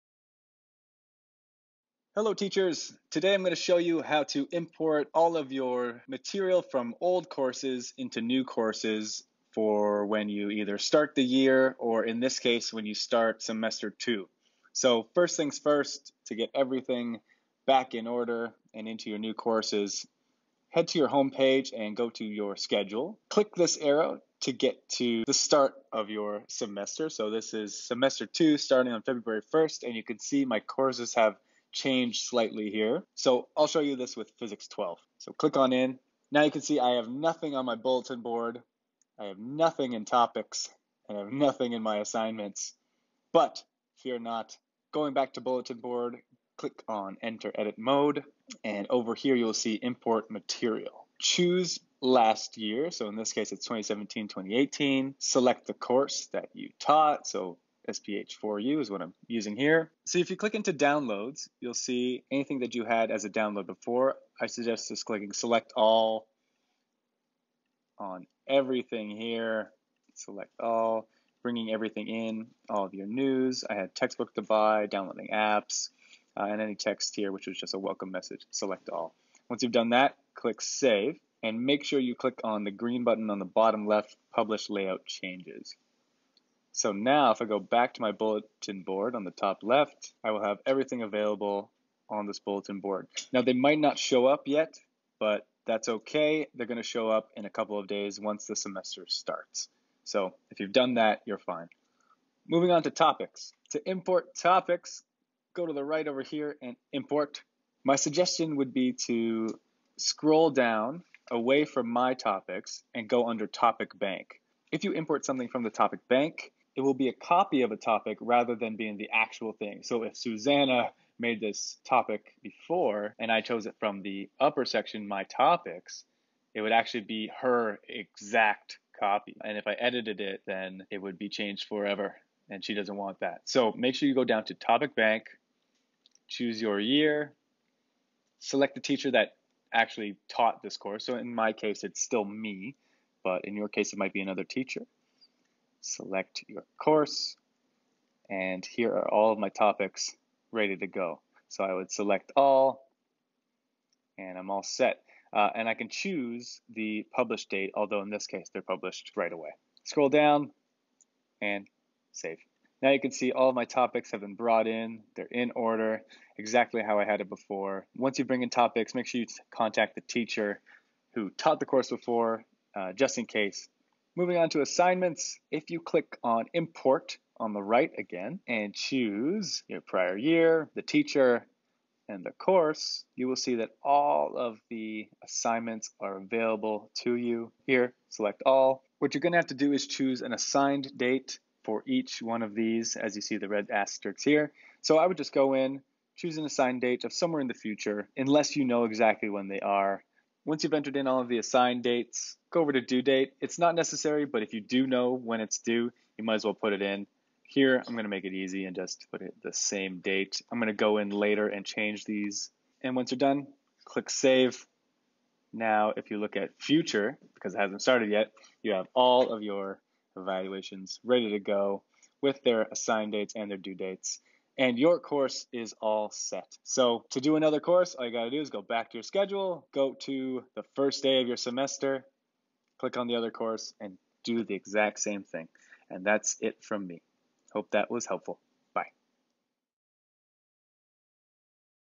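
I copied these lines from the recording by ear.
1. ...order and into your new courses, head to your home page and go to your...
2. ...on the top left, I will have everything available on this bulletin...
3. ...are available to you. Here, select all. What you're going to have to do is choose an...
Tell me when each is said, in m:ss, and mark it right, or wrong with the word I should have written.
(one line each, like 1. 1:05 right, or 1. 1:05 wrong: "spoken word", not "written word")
1. 0:18 right
2. 1:29 right
3. 3:06 right.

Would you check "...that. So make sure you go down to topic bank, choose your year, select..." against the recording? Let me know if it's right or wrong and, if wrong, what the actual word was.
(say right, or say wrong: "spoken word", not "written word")
right.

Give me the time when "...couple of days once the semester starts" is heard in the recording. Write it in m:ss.
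1:37.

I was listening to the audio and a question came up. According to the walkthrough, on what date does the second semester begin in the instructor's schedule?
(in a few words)
February 1st.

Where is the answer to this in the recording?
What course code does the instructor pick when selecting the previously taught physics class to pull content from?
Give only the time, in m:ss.
0:57.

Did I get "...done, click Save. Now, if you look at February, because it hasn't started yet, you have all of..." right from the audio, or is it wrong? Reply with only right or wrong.
wrong.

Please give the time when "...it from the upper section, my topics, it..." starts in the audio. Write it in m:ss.
2:03.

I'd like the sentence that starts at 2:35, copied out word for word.
Uh, and I can choose the publish date, although in this case, they're published right away.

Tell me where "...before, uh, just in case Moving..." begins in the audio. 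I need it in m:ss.
2:51.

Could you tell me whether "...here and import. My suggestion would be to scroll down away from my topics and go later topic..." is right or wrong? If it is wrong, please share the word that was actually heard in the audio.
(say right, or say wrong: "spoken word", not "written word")
wrong: "under", not "later".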